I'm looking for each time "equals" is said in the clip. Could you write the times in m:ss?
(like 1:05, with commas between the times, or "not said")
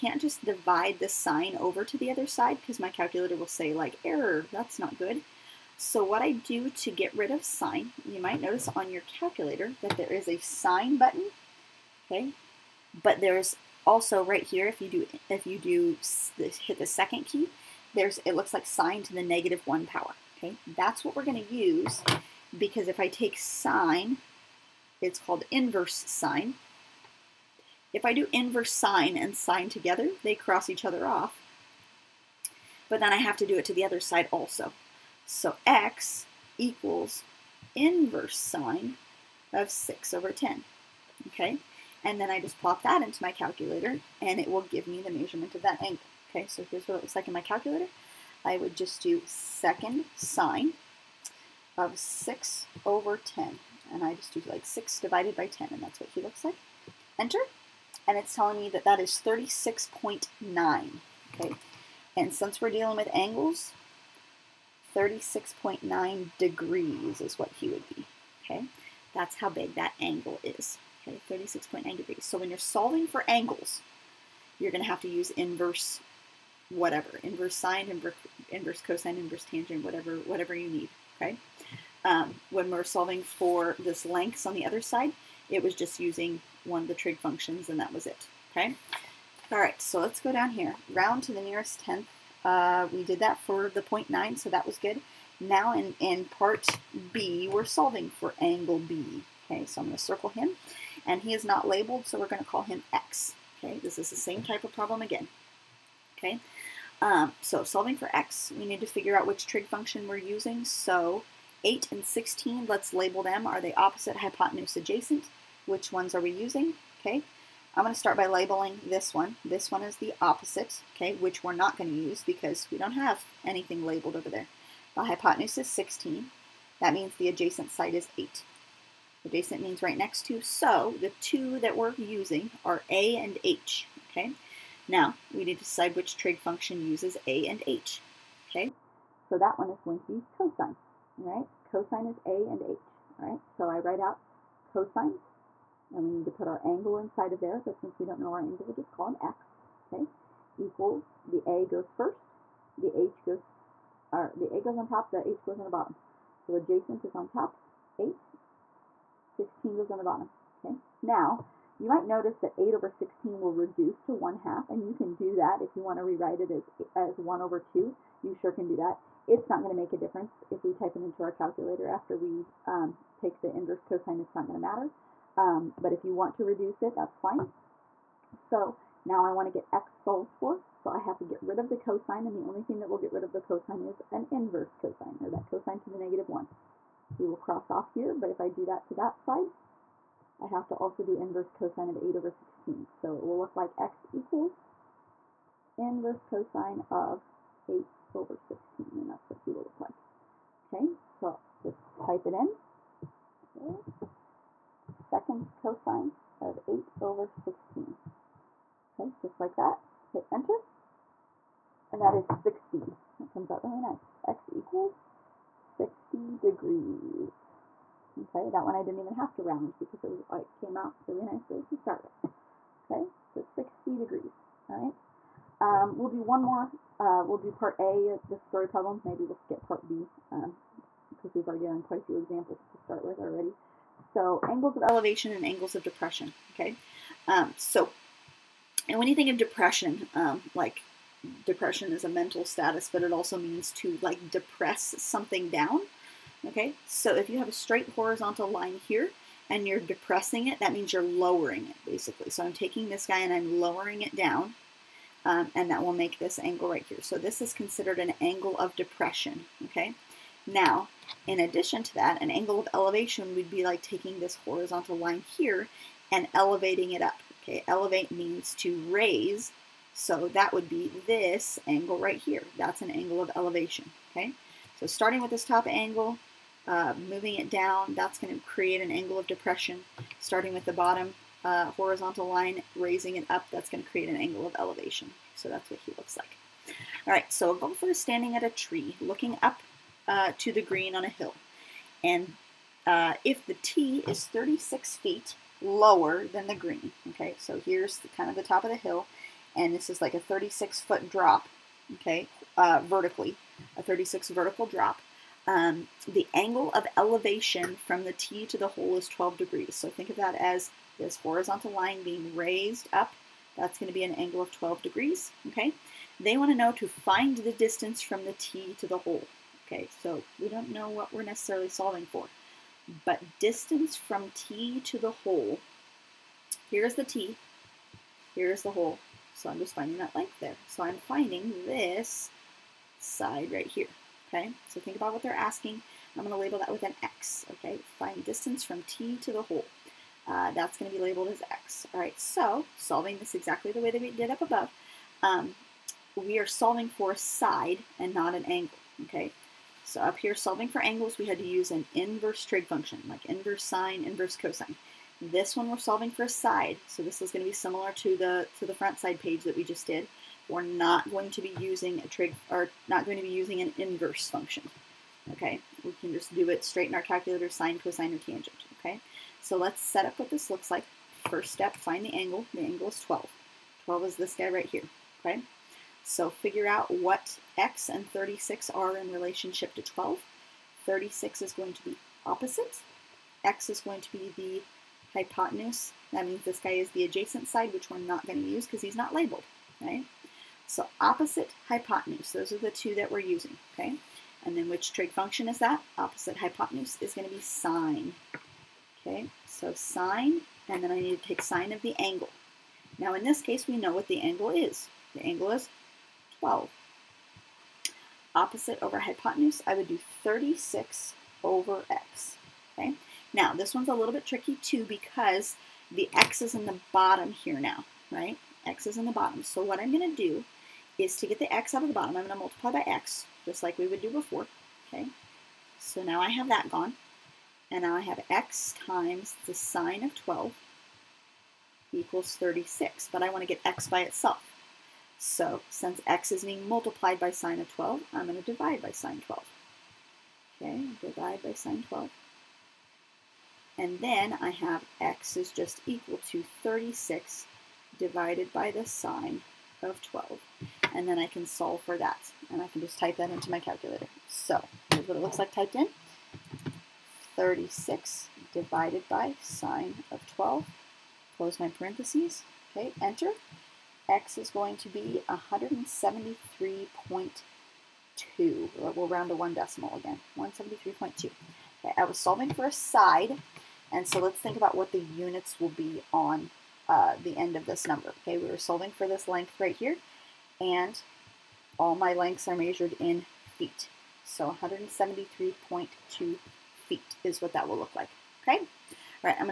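0:36, 2:30, 3:14, 3:34, 7:11, 7:25.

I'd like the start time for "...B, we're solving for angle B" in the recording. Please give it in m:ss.
1:37.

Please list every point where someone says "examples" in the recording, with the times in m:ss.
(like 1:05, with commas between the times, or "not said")
3:52.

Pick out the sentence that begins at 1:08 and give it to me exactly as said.
Okay, that's how big that angle is.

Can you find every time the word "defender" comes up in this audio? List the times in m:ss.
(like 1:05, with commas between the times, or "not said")
not said.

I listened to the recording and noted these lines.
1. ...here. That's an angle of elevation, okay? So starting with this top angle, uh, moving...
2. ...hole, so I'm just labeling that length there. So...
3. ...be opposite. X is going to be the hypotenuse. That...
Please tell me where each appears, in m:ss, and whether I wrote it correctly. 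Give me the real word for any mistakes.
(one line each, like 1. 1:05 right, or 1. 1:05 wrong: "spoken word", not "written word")
1. 4:32 right
2. 5:28 wrong: "finding", not "labeling"
3. 6:21 right.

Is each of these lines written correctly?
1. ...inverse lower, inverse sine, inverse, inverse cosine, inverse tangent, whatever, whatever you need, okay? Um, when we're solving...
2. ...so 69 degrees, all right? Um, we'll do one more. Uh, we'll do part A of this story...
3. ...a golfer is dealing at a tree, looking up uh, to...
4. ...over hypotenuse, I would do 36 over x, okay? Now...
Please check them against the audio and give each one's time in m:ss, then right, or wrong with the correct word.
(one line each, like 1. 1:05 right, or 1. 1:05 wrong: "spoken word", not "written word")
1. 1:15 wrong: "whatever", not "lower"
2. 3:43 wrong: "60", not "69"
3. 4:47 wrong: "standing", not "dealing"
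4. 6:48 right.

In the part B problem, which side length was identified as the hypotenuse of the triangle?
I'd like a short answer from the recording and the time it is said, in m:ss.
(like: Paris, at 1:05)
16, at 2:04.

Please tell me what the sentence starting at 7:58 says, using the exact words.
Okay, we were solving for this length right here, and all my lengths are measured in feet.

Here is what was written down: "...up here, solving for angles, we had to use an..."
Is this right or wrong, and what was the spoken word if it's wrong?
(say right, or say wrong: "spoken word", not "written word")
right.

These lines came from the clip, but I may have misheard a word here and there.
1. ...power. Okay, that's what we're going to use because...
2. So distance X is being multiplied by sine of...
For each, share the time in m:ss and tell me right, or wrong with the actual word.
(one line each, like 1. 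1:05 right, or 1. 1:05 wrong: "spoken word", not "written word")
1. 0:19 right
2. 7:15 wrong: "since", not "distance".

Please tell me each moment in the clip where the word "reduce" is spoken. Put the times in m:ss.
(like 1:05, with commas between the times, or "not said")
2:43, 2:56.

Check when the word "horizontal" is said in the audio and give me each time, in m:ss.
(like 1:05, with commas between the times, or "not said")
4:07, 4:24, 4:41, 5:11.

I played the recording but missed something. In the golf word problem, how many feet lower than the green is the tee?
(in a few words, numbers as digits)
36 feet.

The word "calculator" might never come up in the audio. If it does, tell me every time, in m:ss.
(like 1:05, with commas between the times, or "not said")
0:02, 0:09, 0:43, 0:47, 2:51, 6:07, 7:33.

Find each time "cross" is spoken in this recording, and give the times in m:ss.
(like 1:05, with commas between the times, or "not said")
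0:30, 3:07.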